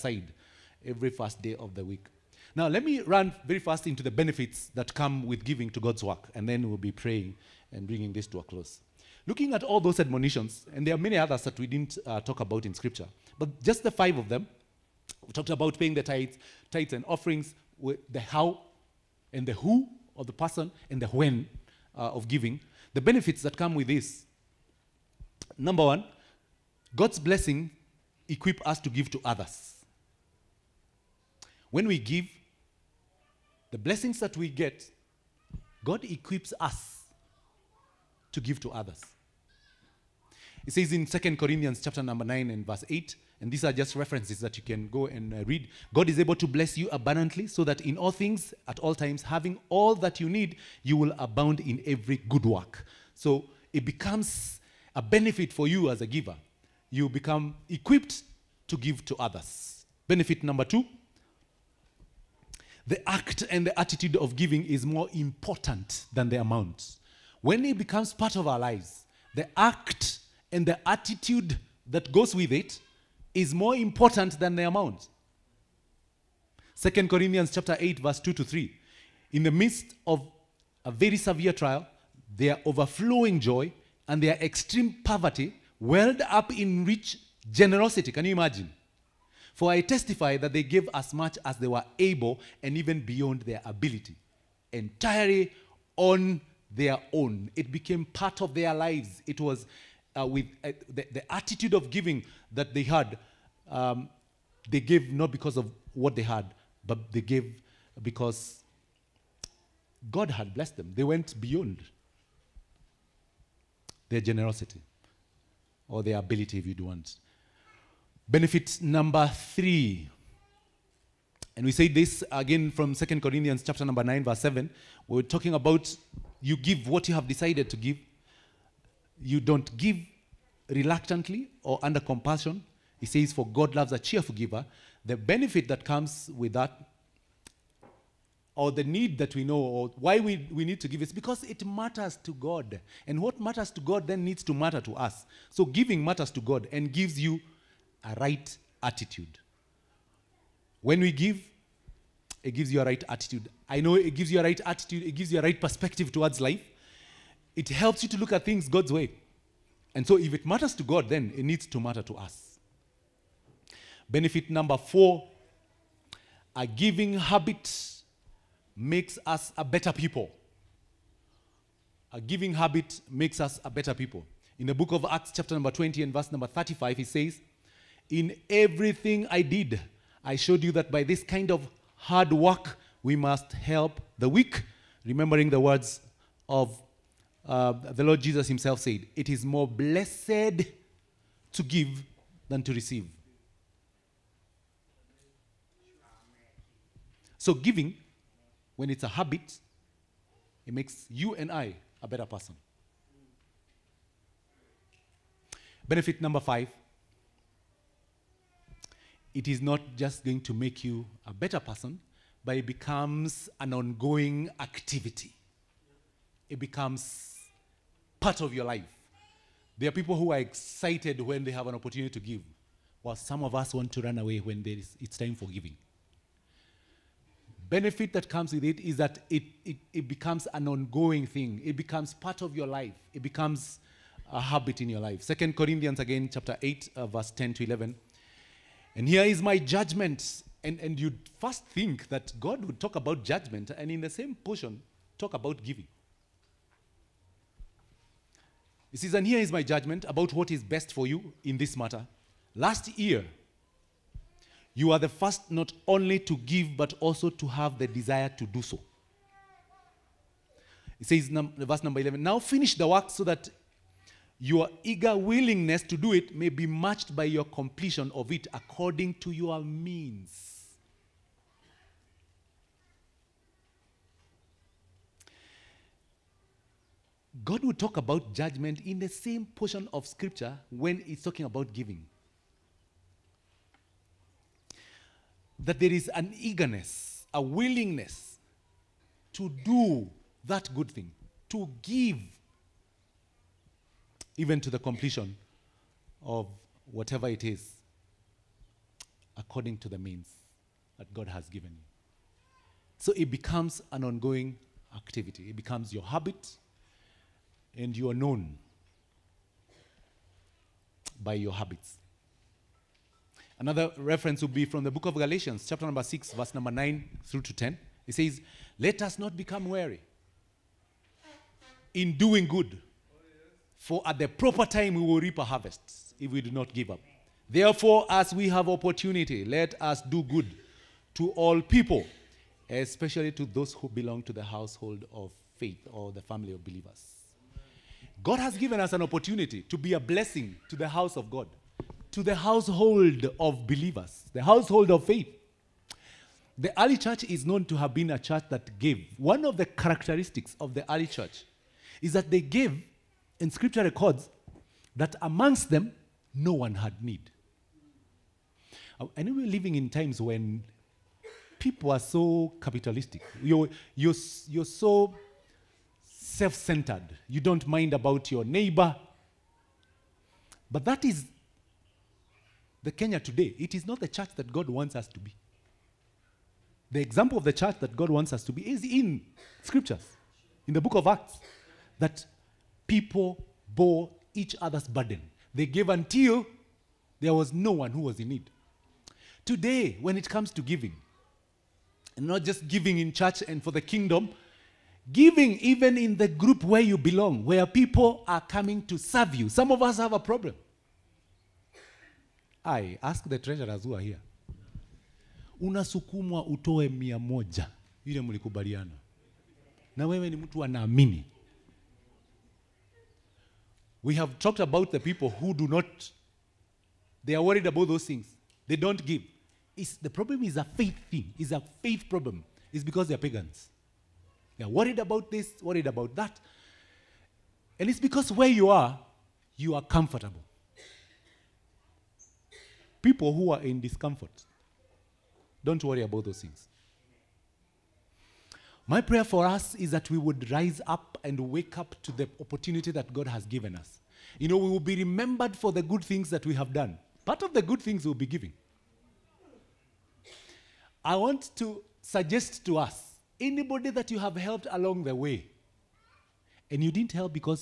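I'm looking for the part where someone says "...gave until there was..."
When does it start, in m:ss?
6:25.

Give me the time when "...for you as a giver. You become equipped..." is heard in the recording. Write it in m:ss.
0:55.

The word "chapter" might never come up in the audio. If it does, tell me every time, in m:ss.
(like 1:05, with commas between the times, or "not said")
0:41, 1:17, 2:03, 2:55, 3:56, 5:15.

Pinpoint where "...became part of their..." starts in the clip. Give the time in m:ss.
1:37.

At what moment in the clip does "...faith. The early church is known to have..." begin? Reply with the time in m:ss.
5:45.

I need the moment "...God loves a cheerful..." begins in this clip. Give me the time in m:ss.
2:13.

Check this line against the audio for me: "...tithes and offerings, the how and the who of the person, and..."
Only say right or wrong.
right.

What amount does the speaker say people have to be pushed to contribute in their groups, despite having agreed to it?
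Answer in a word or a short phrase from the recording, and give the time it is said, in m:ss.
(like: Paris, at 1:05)
100, at 6:46.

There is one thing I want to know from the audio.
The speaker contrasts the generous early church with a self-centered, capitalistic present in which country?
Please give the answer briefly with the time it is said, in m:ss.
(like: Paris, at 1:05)
Kenya, at 6:12.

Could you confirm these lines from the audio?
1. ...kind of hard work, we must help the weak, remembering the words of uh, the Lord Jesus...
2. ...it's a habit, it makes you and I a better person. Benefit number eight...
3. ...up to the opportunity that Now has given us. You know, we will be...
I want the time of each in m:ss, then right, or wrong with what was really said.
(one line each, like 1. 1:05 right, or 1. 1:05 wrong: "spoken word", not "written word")
1. 3:01 right
2. 3:18 wrong: "five", not "eight"
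3. 7:21 wrong: "God", not "Now".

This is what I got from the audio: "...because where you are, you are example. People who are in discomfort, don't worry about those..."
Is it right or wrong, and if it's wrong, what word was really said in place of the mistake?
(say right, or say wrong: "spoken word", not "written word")
wrong: "comfortable", not "example".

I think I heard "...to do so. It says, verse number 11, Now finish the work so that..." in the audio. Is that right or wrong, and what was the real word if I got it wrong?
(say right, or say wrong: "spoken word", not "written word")
right.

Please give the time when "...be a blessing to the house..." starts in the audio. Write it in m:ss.
5:39.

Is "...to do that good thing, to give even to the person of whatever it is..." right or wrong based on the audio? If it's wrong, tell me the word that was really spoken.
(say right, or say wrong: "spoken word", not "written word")
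wrong: "completion", not "person".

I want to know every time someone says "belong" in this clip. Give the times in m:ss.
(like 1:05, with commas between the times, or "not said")
5:33, 6:36.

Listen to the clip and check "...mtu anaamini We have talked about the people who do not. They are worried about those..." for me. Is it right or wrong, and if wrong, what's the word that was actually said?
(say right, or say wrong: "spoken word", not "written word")
right.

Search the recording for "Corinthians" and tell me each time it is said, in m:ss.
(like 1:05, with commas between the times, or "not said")
0:41, 1:17, 2:03, 3:55.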